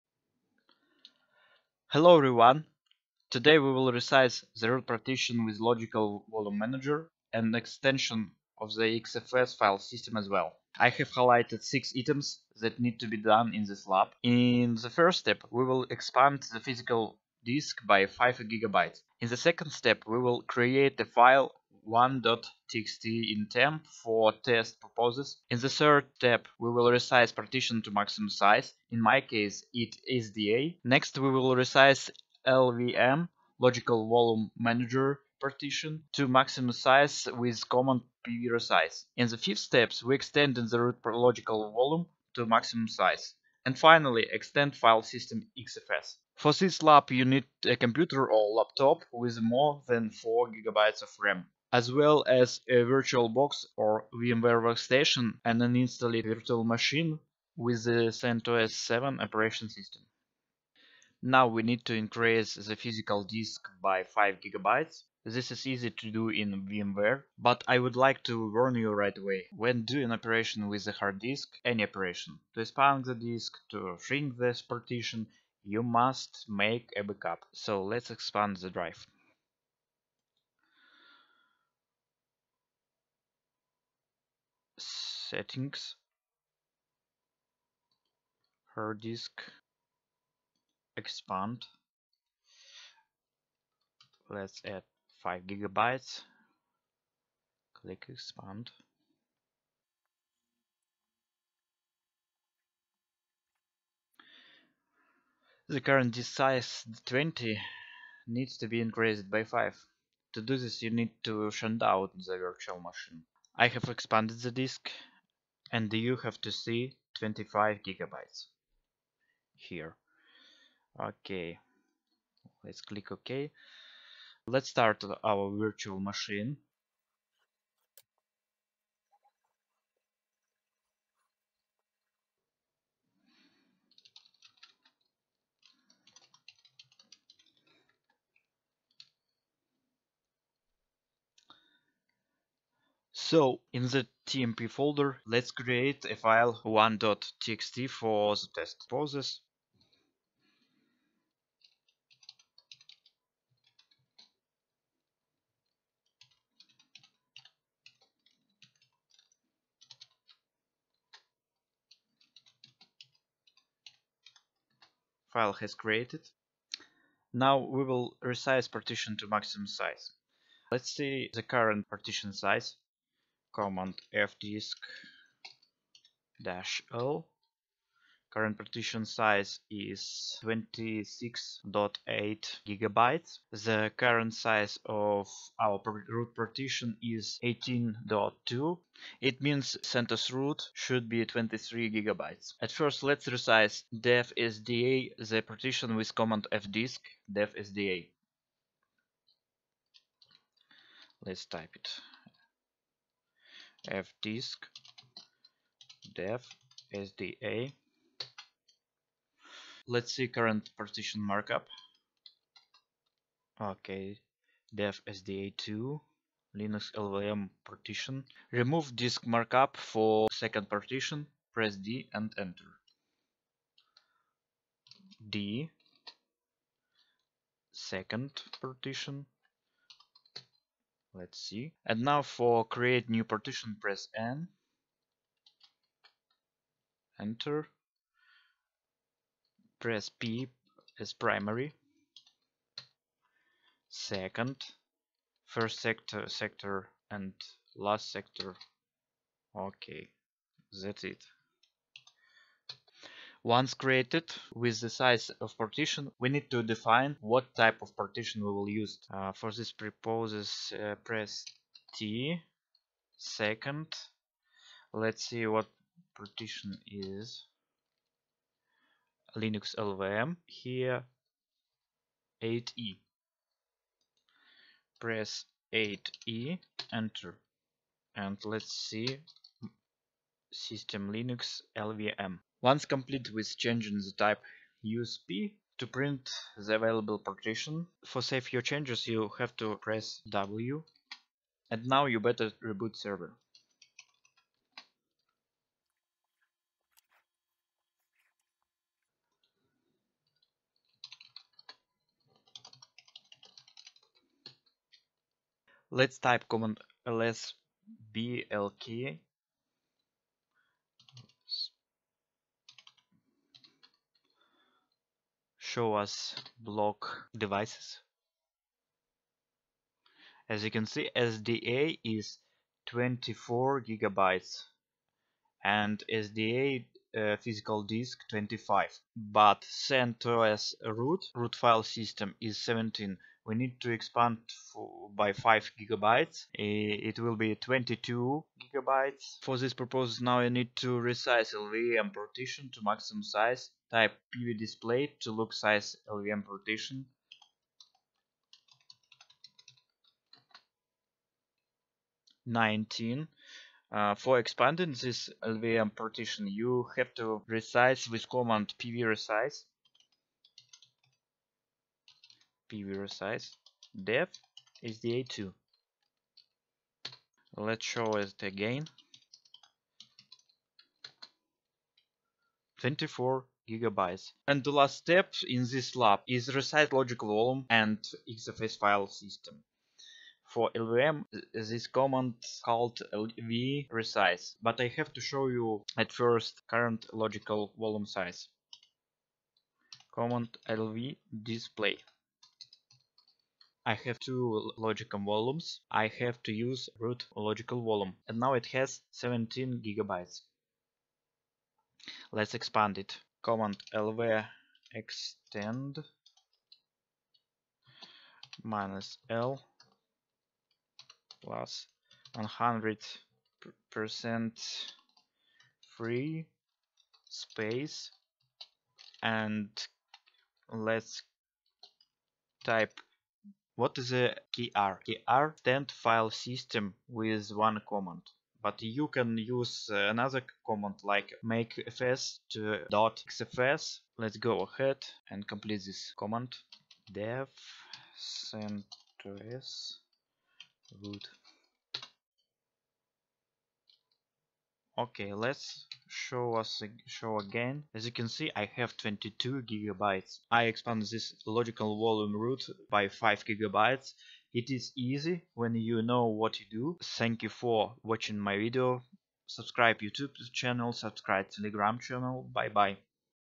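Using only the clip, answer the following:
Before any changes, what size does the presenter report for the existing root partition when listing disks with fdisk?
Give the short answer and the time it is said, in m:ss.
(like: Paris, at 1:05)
18.2, at 3:07.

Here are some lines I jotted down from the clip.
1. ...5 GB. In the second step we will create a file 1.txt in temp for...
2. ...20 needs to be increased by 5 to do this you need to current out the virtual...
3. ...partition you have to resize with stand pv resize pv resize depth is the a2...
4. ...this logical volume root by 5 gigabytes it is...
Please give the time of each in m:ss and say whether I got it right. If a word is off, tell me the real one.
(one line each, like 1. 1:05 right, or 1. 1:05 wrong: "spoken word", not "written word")
1. 0:18 right
2. 1:47 wrong: "shunt", not "current"
3. 5:55 wrong: "command", not "stand"
4. 7:31 right.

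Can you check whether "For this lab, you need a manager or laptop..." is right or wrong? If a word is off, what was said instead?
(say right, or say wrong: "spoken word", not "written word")
wrong: "computer", not "manager".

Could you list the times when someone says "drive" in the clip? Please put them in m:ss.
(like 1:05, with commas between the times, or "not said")
1:18.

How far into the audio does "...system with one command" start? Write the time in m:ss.
7:06.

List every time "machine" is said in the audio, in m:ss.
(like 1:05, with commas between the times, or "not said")
0:56, 1:52, 2:05.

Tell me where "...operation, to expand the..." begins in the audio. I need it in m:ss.
1:11.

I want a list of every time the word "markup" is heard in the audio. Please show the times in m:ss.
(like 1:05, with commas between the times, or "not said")
3:31, 3:39.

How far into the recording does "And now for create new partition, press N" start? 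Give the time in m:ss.
3:51.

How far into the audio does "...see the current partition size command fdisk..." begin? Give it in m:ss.
2:50.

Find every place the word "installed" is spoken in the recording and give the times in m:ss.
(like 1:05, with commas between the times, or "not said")
0:55.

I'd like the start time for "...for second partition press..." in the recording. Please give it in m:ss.
3:39.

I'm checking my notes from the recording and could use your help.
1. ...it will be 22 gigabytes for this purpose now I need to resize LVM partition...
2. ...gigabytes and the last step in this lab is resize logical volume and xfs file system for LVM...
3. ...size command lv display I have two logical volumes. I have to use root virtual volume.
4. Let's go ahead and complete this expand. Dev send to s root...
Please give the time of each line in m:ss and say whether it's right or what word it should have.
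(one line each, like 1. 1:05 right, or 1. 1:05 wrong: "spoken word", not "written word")
1. 5:36 right
2. 6:13 right
3. 6:28 wrong: "logical", not "virtual"
4. 7:14 wrong: "command", not "expand".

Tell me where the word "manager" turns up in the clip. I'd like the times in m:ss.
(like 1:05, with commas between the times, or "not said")
0:06, 0:34.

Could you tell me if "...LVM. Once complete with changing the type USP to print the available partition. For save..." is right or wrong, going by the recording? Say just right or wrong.
right.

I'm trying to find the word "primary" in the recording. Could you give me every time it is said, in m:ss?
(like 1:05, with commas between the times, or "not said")
4:01.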